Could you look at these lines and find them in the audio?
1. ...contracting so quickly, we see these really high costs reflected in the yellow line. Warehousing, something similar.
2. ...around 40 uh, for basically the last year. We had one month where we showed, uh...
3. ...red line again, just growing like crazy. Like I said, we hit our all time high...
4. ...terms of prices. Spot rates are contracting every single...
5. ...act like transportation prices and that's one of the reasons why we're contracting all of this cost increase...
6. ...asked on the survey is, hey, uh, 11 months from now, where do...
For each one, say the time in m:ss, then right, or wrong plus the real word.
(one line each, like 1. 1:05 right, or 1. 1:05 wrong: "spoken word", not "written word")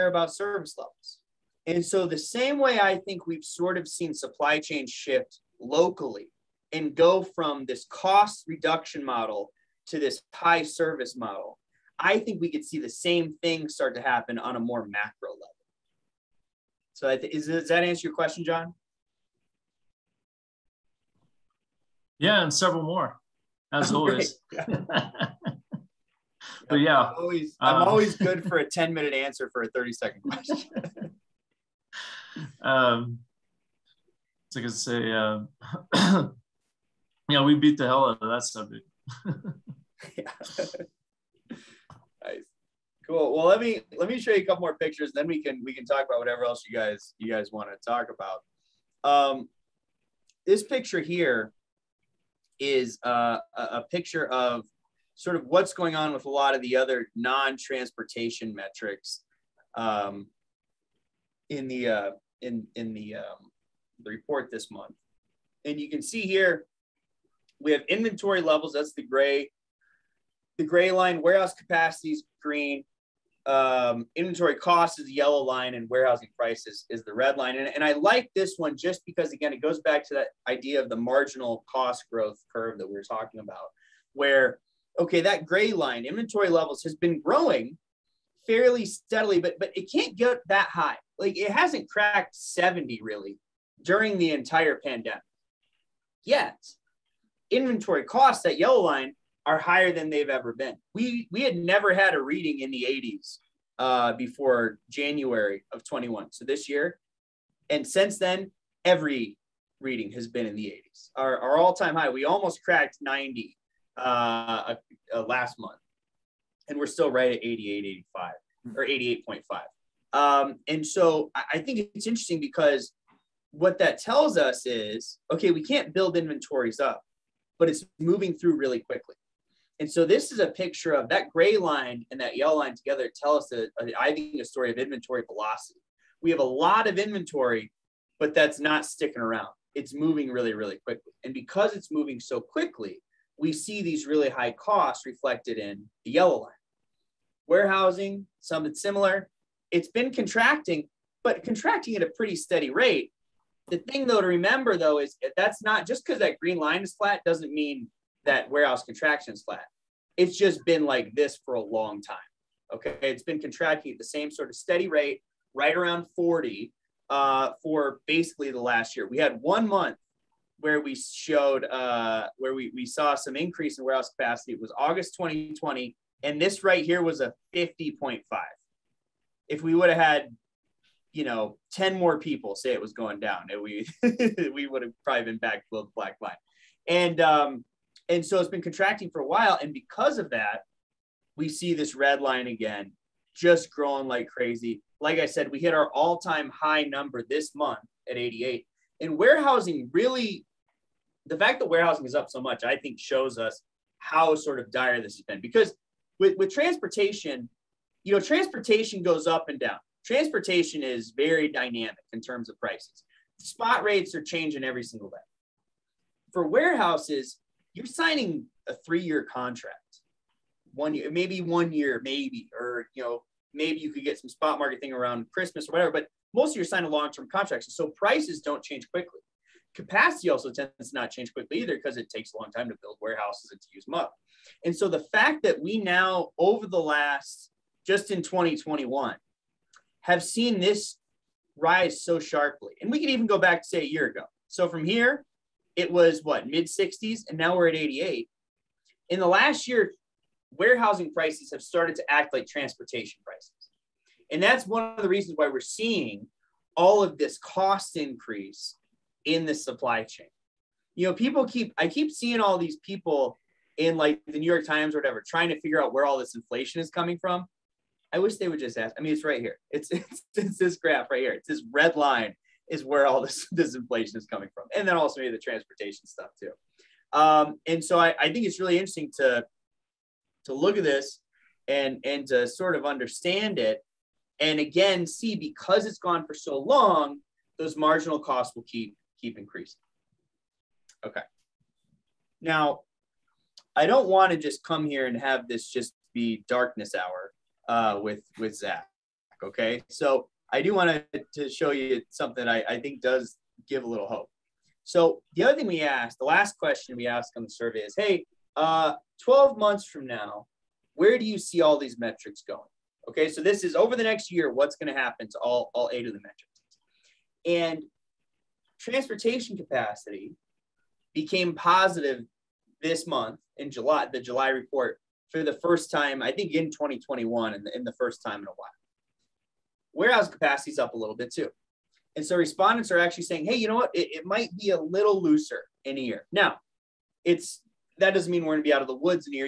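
1. 2:21 wrong: "moving", not "contracting"
2. 2:45 right
3. 3:11 right
4. 3:32 wrong: "changing", not "contracting"
5. 4:12 wrong: "seeing", not "contracting"
6. 5:07 wrong: "12", not "11".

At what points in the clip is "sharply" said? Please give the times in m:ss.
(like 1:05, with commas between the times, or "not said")
4:02.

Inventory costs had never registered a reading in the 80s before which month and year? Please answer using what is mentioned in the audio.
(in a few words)
January 2021.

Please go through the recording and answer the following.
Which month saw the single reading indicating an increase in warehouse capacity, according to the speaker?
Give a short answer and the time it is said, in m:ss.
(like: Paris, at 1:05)
August 2020, at 2:54.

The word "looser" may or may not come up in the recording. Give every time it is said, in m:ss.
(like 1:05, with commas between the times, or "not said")
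5:35.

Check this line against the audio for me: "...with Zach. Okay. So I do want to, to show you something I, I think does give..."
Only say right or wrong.
right.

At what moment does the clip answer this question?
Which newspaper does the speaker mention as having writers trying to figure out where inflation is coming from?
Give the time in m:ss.
4:24.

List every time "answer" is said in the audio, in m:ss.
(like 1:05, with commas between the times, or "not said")
0:17, 0:29.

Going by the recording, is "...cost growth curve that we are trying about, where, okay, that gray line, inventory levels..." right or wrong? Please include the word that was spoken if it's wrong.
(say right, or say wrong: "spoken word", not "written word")
wrong: "talking", not "trying".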